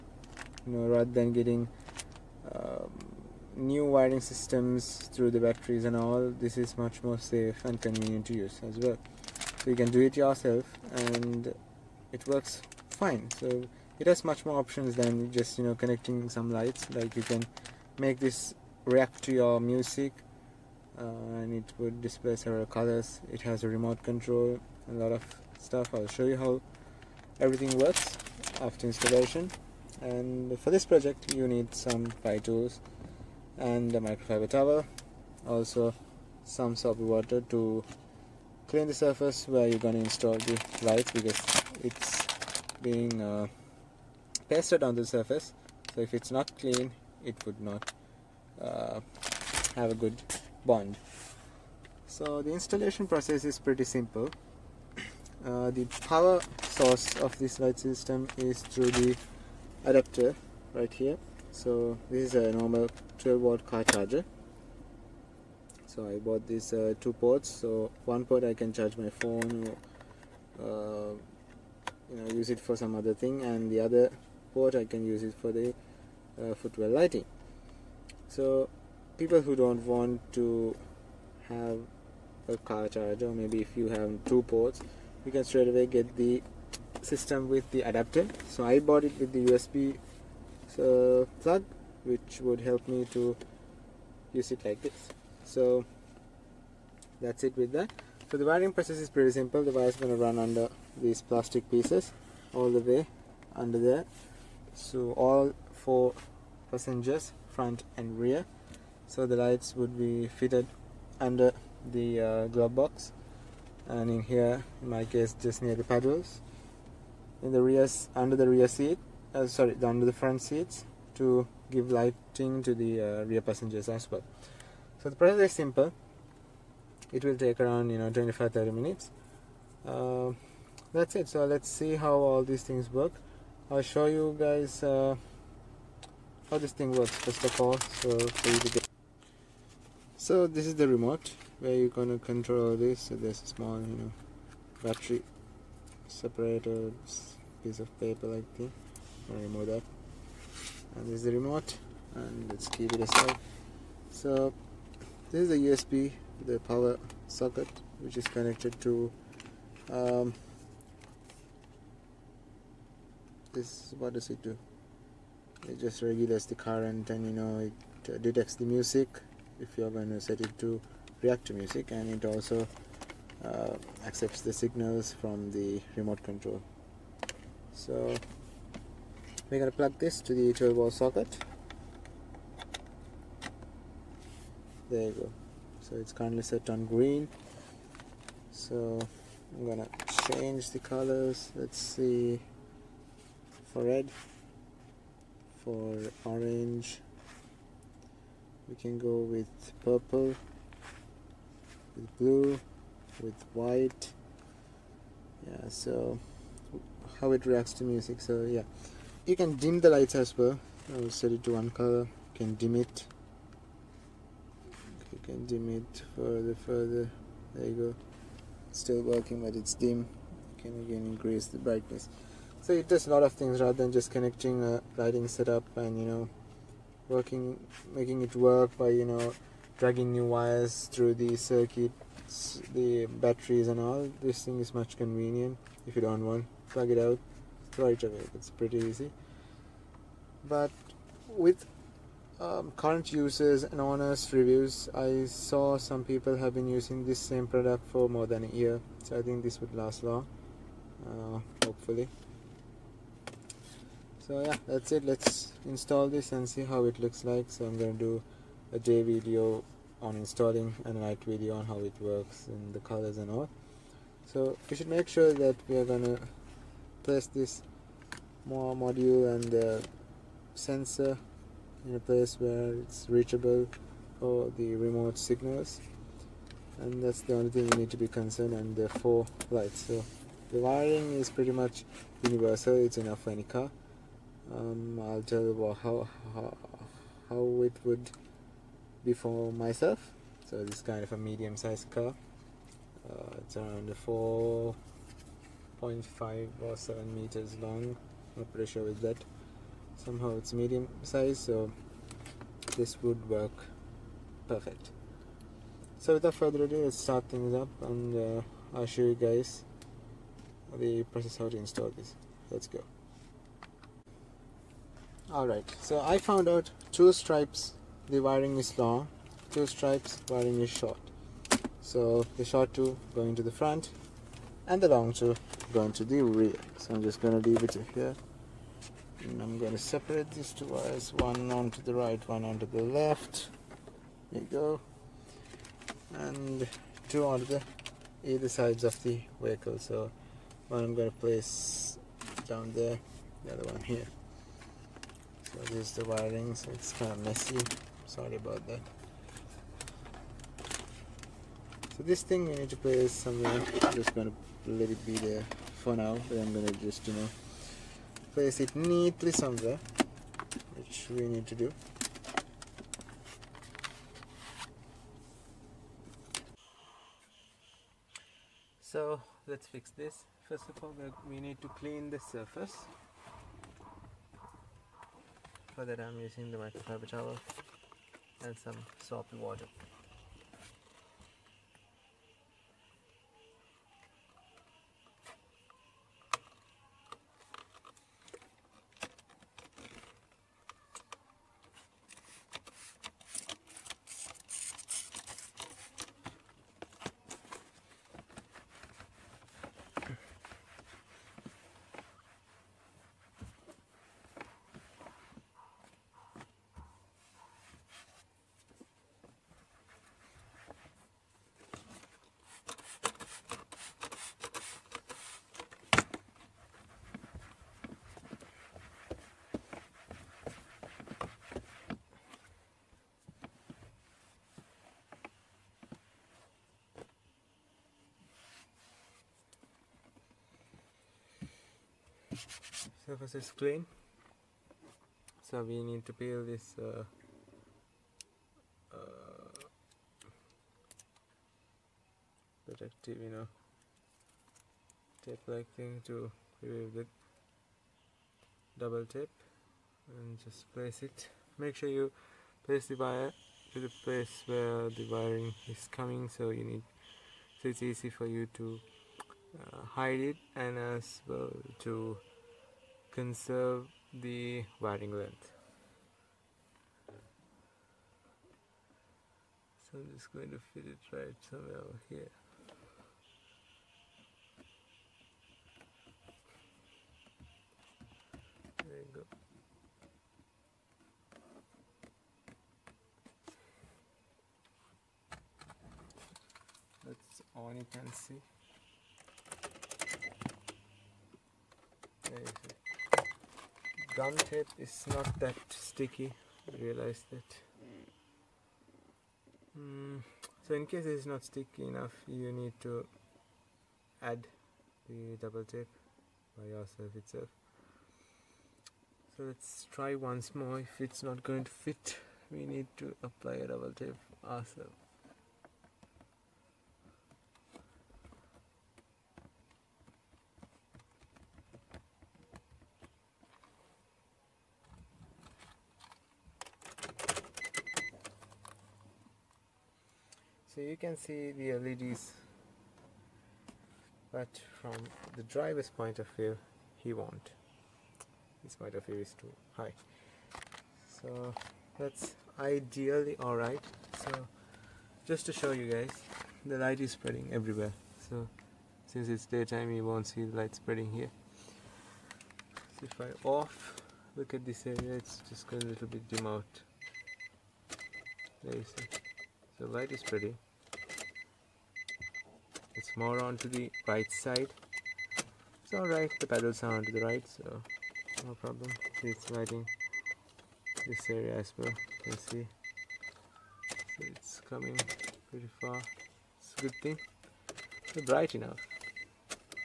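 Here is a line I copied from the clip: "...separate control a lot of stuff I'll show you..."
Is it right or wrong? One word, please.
wrong.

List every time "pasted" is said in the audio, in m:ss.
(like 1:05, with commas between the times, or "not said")
0:44.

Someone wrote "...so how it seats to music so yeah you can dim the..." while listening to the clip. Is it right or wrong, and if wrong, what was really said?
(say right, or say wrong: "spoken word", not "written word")
wrong: "reacts", not "seats".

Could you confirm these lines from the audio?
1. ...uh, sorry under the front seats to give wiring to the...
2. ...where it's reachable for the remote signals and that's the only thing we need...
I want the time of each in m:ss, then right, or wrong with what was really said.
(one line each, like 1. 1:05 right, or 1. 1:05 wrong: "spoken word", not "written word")
1. 1:59 wrong: "lighting", not "wiring"
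2. 4:32 right.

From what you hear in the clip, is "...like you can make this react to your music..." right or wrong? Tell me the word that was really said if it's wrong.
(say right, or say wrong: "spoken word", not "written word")
right.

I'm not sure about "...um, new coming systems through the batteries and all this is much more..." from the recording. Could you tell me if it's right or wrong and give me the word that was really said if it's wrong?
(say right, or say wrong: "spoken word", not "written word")
wrong: "wiring", not "coming".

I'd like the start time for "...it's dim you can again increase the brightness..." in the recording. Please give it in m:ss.
3:39.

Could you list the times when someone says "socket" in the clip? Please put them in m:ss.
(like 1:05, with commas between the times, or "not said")
2:37, 3:00.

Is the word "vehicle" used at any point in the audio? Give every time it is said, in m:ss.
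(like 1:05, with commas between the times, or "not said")
5:39.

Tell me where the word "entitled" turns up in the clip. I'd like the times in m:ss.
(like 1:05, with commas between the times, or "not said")
not said.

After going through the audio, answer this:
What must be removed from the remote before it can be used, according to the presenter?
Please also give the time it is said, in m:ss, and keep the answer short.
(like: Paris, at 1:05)
a piece of paper, at 2:26.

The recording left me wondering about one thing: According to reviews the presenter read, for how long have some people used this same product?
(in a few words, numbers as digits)
more than a year.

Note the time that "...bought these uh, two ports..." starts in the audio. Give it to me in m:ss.
1:06.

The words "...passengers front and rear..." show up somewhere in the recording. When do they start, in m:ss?
1:46.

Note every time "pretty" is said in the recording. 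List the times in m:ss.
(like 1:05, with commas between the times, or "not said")
0:53, 1:39, 3:58, 4:41, 4:58, 9:35.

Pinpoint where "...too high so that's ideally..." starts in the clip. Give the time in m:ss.
8:59.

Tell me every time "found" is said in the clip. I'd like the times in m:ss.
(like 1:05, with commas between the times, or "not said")
5:16.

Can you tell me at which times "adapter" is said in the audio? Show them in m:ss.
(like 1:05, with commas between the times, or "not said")
0:59, 1:27.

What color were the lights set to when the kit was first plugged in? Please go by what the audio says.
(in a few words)
green.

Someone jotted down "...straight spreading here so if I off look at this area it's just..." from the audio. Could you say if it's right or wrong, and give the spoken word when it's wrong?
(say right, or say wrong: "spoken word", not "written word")
wrong: "light", not "straight".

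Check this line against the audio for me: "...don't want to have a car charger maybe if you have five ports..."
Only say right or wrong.
wrong.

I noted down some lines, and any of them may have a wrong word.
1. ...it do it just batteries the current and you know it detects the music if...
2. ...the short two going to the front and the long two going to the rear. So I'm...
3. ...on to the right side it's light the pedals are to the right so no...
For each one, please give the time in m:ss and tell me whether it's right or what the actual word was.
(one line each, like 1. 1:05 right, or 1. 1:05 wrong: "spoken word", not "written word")
1. 2:44 wrong: "regulates", not "batteries"
2. 5:22 right
3. 9:23 wrong: "alright", not "light".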